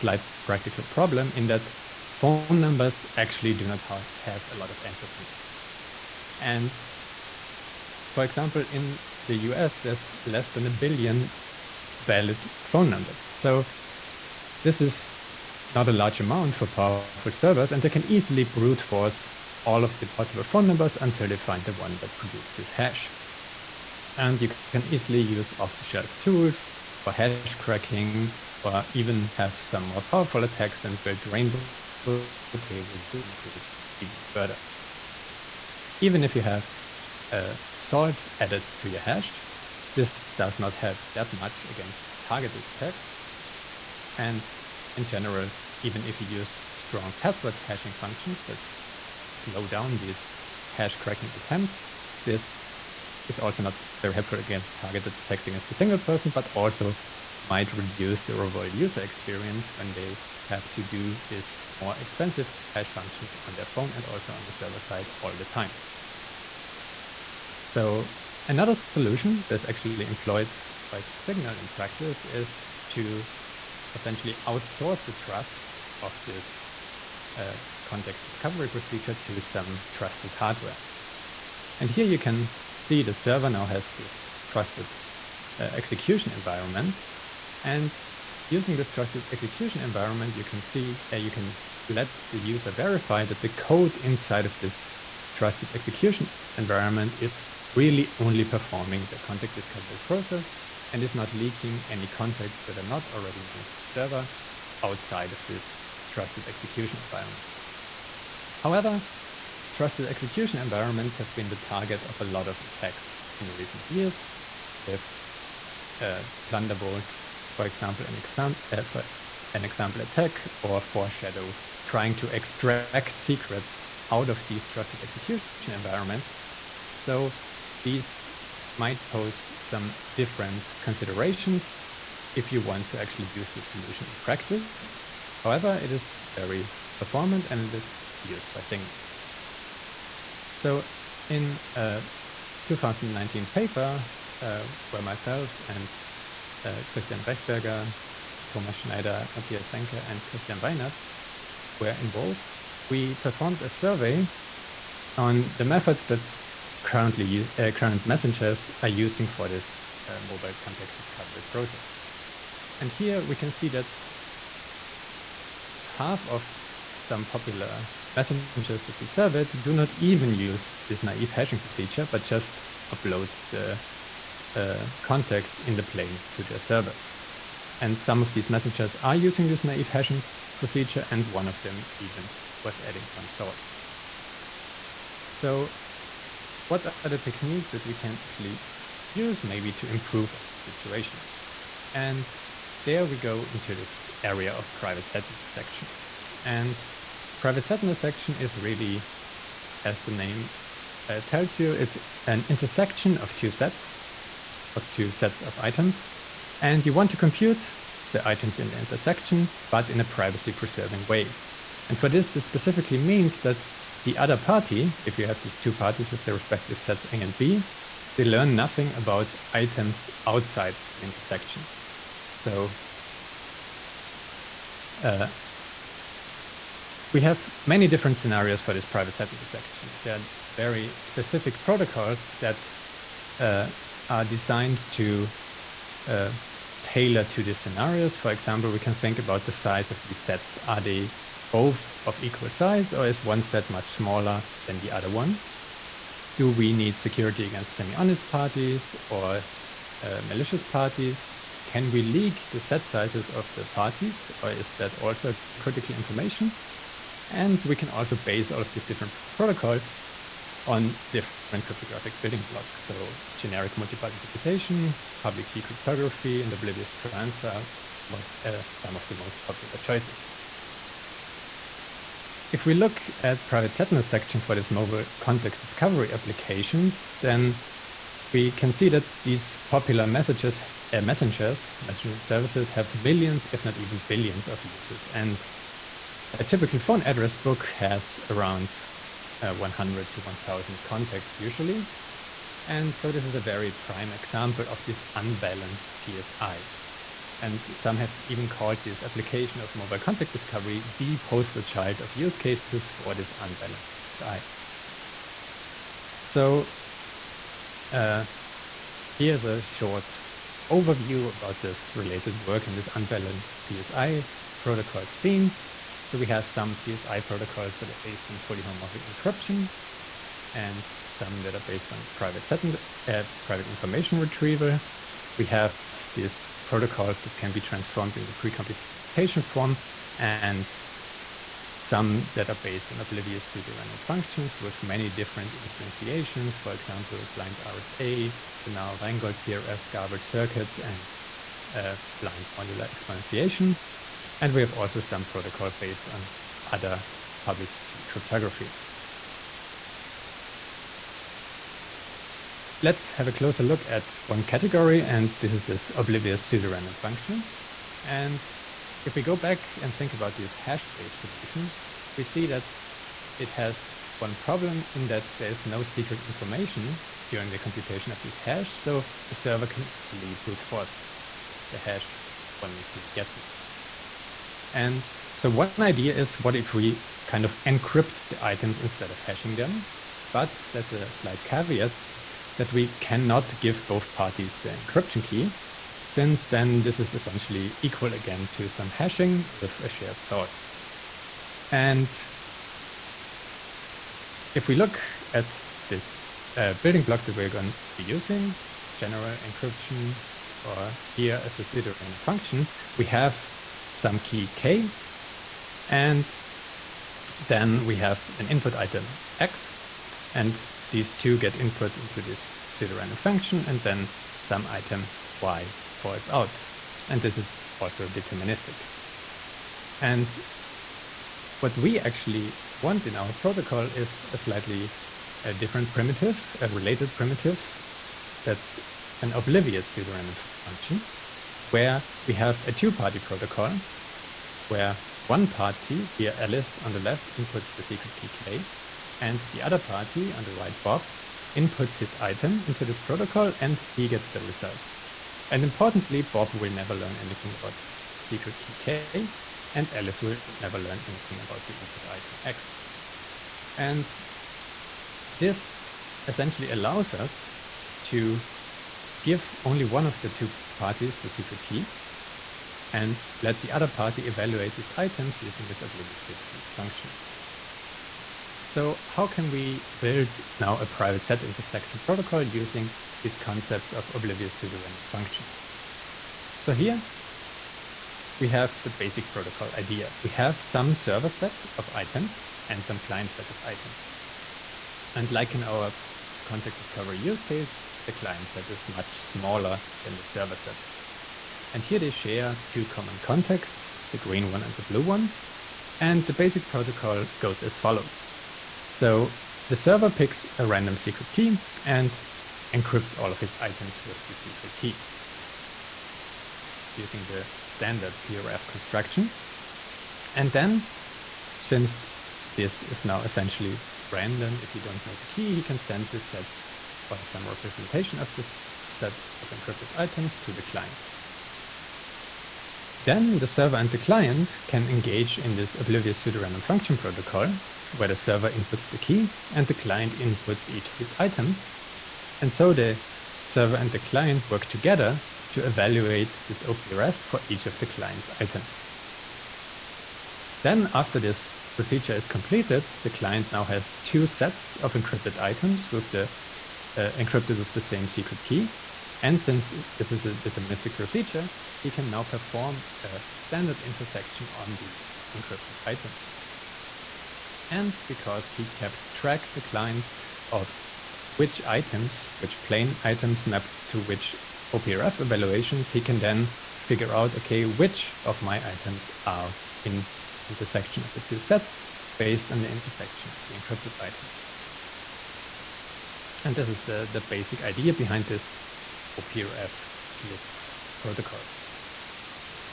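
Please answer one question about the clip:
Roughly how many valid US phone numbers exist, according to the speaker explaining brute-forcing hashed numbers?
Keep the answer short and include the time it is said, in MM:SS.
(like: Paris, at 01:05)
less than a billion, at 00:10.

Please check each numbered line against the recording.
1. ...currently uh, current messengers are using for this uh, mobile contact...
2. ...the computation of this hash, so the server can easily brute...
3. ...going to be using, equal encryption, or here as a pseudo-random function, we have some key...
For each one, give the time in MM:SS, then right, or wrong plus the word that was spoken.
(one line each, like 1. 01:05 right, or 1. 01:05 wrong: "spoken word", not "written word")
1. 02:36 right
2. 06:07 right
3. 06:37 wrong: "general", not "equal".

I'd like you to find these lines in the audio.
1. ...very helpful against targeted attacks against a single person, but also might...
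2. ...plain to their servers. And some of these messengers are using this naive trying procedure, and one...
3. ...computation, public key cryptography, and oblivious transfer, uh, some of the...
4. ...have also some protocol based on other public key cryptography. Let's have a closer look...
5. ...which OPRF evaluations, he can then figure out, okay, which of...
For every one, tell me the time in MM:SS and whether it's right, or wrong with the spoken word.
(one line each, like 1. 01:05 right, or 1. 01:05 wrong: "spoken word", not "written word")
1. 00:54 right
2. 02:55 wrong: "hashing", not "trying"
3. 04:24 right
4. 05:44 right
5. 09:23 right.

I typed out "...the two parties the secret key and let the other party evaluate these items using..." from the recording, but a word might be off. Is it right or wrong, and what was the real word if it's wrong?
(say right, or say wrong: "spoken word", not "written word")
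right.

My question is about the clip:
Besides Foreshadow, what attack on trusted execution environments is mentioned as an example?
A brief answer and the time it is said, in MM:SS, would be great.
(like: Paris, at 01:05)
Plundervolt, at 01:56.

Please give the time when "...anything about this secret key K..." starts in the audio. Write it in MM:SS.
07:27.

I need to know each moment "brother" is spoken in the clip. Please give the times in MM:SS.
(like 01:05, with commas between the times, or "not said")
not said.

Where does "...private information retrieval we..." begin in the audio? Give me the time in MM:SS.
05:23.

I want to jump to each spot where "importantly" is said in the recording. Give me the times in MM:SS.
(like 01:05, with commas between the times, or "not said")
07:25.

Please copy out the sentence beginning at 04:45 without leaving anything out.
And a typical phone address book has around uh, 100 to 1000 contacts usually.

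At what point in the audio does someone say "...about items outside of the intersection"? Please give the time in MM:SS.
03:38.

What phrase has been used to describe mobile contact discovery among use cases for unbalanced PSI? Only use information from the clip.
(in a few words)
poster child.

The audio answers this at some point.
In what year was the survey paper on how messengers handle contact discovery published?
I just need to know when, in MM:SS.
02:22.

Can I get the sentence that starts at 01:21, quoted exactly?
And here you can see the server now has this trusted uh, execution environment.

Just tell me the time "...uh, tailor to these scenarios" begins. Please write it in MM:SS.
03:56.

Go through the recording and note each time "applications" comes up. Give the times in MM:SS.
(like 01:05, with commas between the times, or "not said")
04:36, 04:59.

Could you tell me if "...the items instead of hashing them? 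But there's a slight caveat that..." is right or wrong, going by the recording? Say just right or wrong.
right.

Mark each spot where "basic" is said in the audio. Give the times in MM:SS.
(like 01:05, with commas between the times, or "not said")
07:58, 08:16, 09:37.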